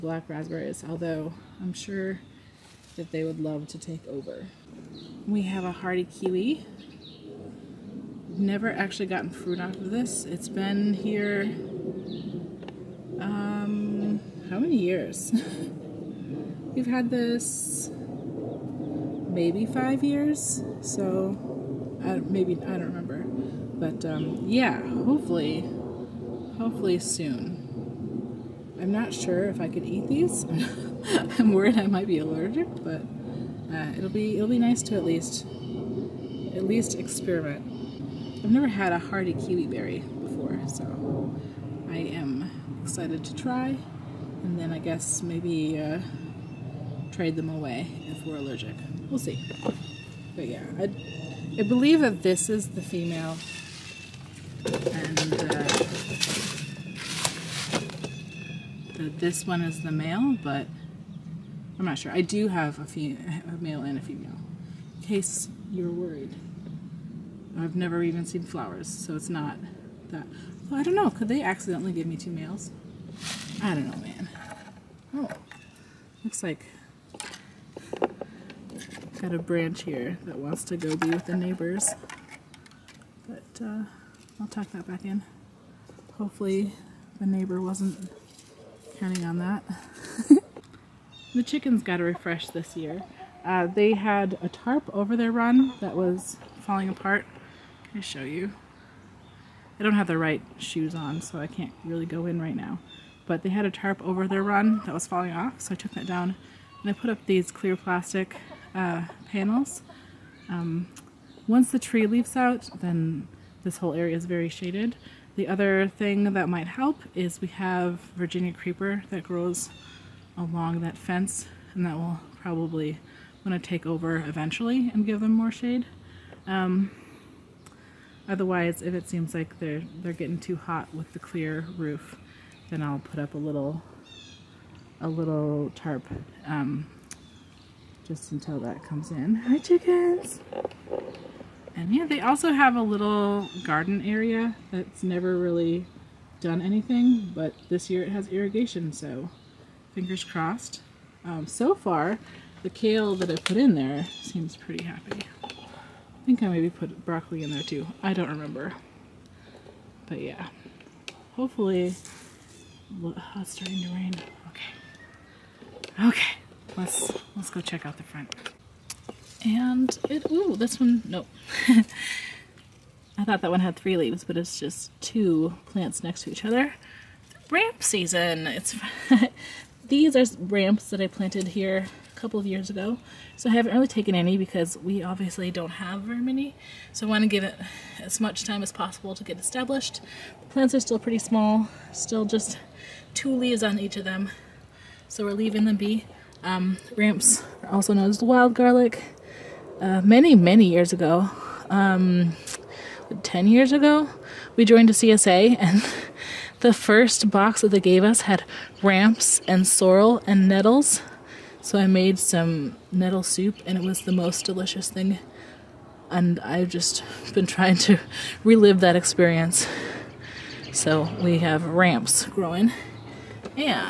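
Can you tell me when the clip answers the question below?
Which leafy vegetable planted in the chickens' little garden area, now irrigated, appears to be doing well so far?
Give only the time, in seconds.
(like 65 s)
152 s.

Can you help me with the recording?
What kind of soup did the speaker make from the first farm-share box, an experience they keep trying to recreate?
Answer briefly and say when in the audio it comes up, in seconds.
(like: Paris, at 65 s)
Nettle soup, at 212 s.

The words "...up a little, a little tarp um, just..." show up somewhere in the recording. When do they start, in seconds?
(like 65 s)
133 s.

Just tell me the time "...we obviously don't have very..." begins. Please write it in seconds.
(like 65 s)
184 s.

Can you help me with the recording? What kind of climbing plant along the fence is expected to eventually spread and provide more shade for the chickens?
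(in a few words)
Virginia creeper.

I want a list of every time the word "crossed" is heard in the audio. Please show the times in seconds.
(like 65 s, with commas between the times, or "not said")
150 s.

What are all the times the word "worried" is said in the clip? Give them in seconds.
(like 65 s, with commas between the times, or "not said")
31 s, 65 s.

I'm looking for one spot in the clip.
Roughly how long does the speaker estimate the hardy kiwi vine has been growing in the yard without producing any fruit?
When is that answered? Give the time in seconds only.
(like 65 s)
19 s.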